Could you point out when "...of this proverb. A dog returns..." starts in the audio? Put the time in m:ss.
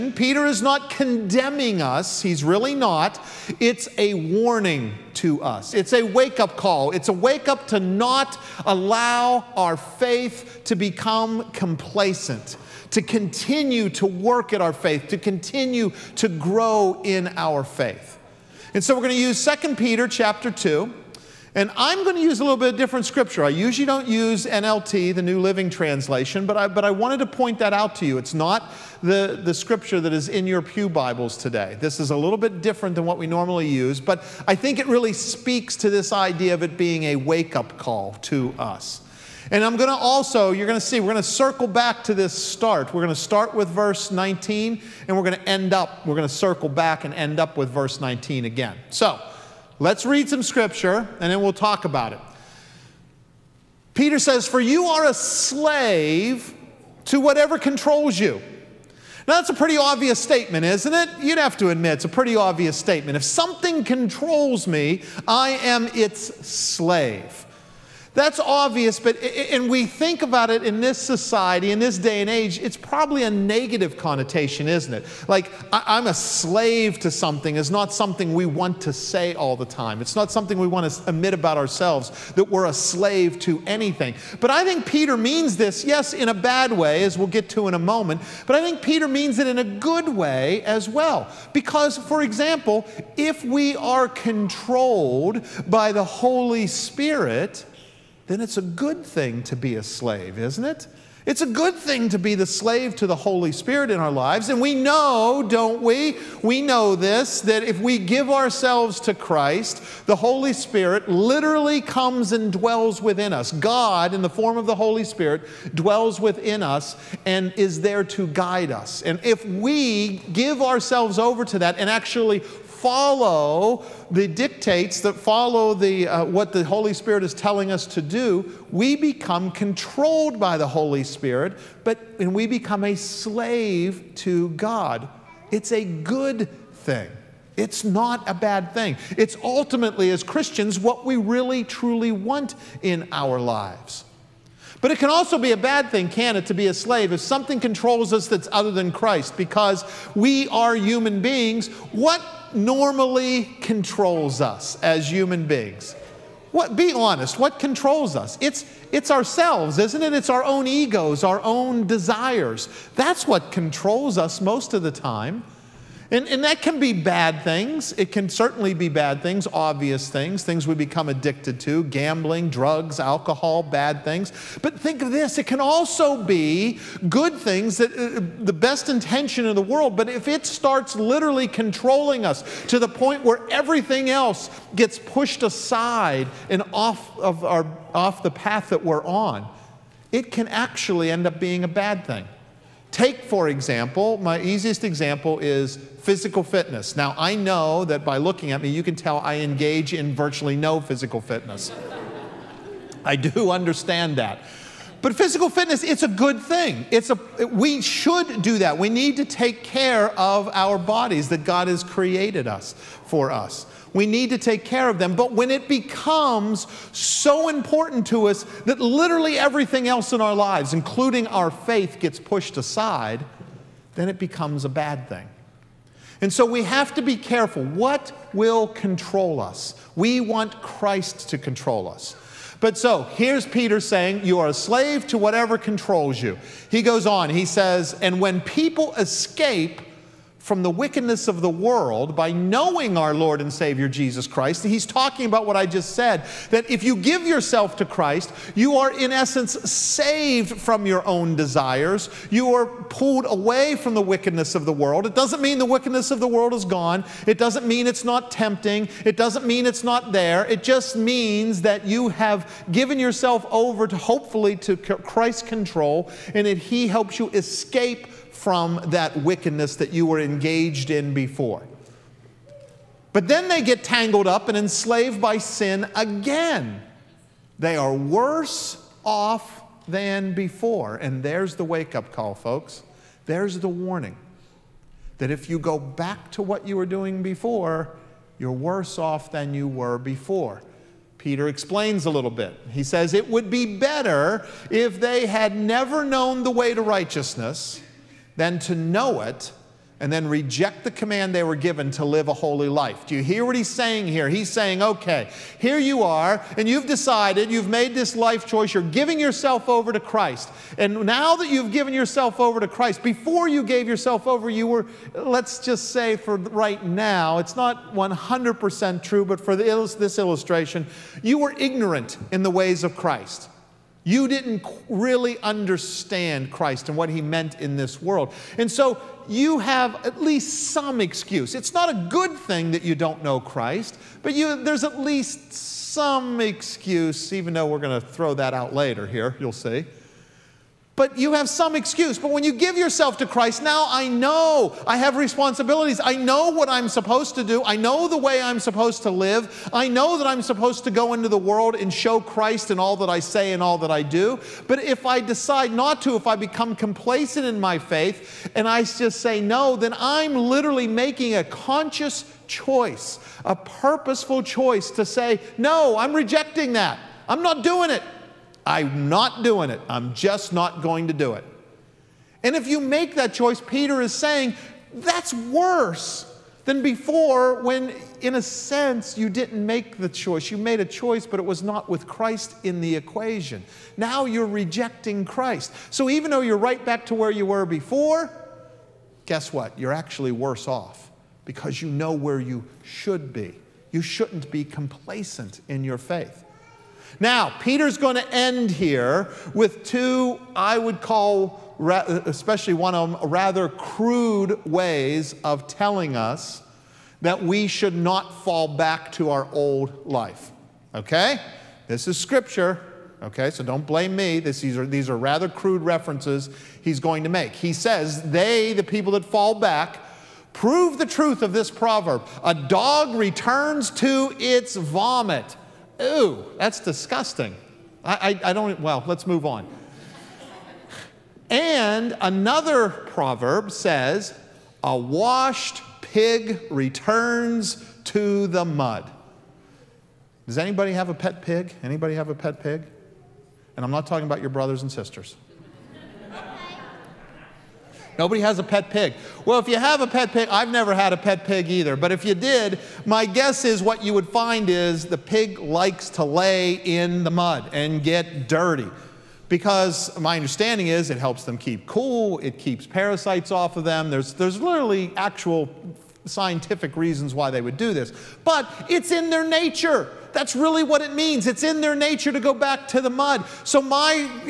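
7:01.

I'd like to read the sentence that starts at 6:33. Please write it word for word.
You shouldn't be complacent in your faith.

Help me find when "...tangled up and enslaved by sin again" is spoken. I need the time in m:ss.
4:33.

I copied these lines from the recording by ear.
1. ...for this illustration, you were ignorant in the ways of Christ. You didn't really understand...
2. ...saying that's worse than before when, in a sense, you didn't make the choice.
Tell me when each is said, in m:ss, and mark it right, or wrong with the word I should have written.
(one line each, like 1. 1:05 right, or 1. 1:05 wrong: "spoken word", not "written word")
1. 5:19 right
2. 6:14 right.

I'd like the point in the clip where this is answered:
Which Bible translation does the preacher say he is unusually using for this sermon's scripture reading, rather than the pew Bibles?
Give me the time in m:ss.
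0:25.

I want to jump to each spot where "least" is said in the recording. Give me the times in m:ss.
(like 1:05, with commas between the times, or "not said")
5:30, 5:34.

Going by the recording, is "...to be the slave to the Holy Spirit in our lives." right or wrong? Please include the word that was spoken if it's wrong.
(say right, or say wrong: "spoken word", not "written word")
right.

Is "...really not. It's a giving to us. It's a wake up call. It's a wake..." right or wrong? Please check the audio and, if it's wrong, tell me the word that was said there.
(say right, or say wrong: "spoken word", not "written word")
wrong: "warning", not "giving".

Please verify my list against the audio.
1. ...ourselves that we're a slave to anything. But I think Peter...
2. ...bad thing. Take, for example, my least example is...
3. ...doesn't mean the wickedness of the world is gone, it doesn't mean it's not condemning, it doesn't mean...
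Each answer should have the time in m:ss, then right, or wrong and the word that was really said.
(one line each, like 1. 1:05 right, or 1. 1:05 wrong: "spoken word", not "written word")
1. 1:21 right
2. 3:11 wrong: "easiest", not "least"
3. 4:15 wrong: "tempting", not "condemning".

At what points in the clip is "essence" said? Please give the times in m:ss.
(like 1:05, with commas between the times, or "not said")
4:09.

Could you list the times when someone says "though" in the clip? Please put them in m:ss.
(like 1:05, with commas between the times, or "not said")
5:37, 6:26.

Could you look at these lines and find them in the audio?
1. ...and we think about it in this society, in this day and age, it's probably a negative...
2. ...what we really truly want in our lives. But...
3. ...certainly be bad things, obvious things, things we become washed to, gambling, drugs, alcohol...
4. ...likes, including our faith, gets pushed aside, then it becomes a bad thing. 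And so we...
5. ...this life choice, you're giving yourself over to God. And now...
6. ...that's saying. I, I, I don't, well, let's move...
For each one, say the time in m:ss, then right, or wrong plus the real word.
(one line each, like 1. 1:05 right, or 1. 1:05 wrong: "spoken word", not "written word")
1. 1:09 right
2. 2:20 right
3. 2:48 wrong: "addicted", not "washed"
4. 3:40 wrong: "lives", not "likes"
5. 5:07 wrong: "Christ", not "God"
6. 7:06 wrong: "disgusting", not "saying".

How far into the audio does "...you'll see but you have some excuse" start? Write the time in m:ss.
5:39.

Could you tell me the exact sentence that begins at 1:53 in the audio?
God, in the form of the Holy Spirit, dwells within us and is there to guide us.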